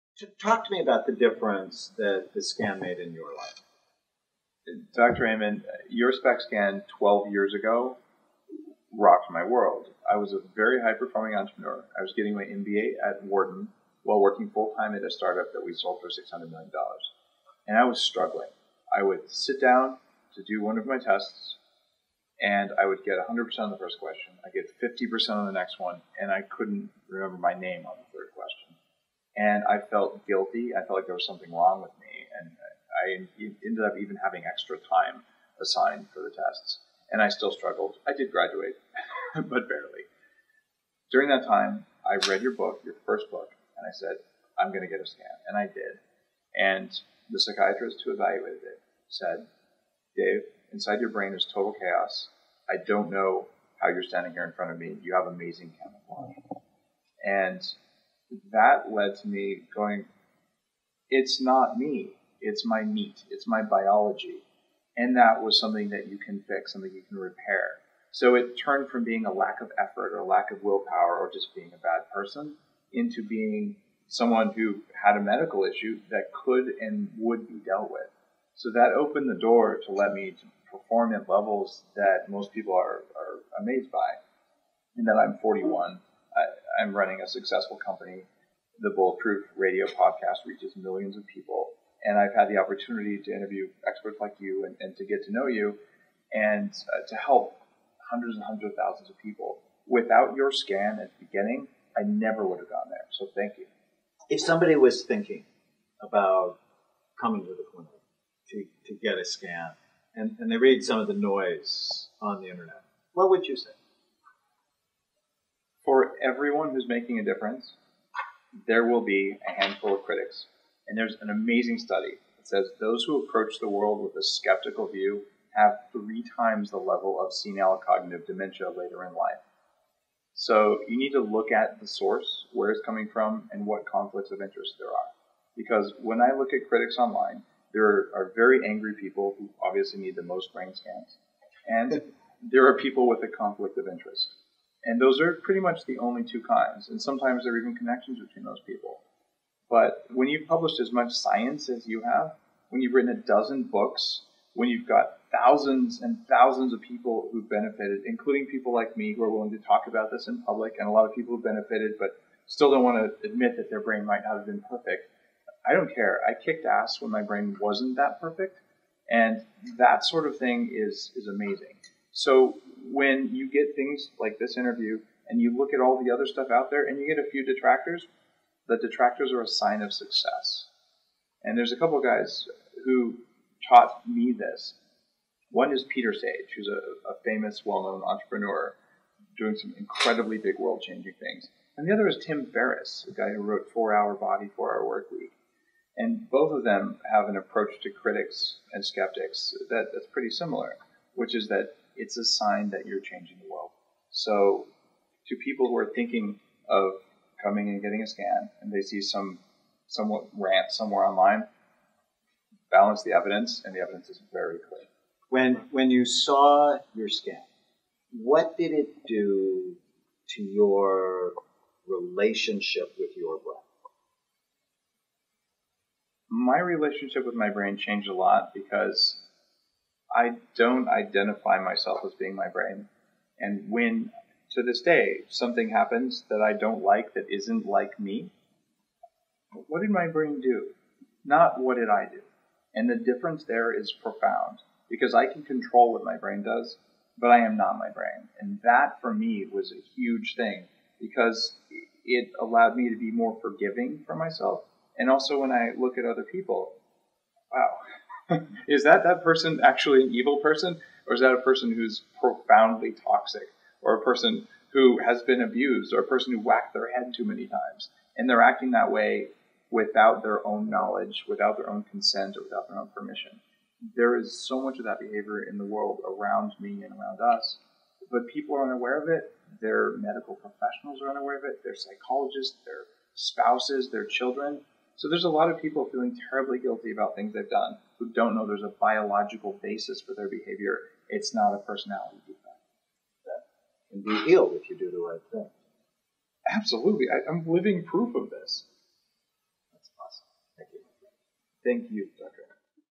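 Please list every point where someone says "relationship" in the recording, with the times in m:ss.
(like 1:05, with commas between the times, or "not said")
3:41, 3:46.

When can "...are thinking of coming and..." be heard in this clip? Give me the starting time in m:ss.
3:25.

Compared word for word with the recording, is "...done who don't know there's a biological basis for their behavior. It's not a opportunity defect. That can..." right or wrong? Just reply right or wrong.
wrong.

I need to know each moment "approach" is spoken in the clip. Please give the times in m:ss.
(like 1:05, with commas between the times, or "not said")
2:03, 3:17.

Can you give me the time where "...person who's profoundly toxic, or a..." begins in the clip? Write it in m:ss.
4:21.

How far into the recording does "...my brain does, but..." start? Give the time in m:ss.
4:06.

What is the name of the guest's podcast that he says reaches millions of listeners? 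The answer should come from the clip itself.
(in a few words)
Bulletproof Radio.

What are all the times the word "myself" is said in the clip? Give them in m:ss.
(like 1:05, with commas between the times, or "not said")
3:51, 4:14.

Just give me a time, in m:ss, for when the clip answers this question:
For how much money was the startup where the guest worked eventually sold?
0:16.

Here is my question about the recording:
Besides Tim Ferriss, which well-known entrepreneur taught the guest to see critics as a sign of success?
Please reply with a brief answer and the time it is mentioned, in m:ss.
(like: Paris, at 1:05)
Peter Sage, at 3:05.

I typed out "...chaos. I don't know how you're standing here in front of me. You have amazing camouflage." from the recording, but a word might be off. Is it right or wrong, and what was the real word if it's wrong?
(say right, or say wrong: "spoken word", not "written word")
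right.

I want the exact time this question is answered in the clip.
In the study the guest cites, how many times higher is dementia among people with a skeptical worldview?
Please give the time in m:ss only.
2:05.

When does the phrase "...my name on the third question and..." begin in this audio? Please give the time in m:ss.
0:27.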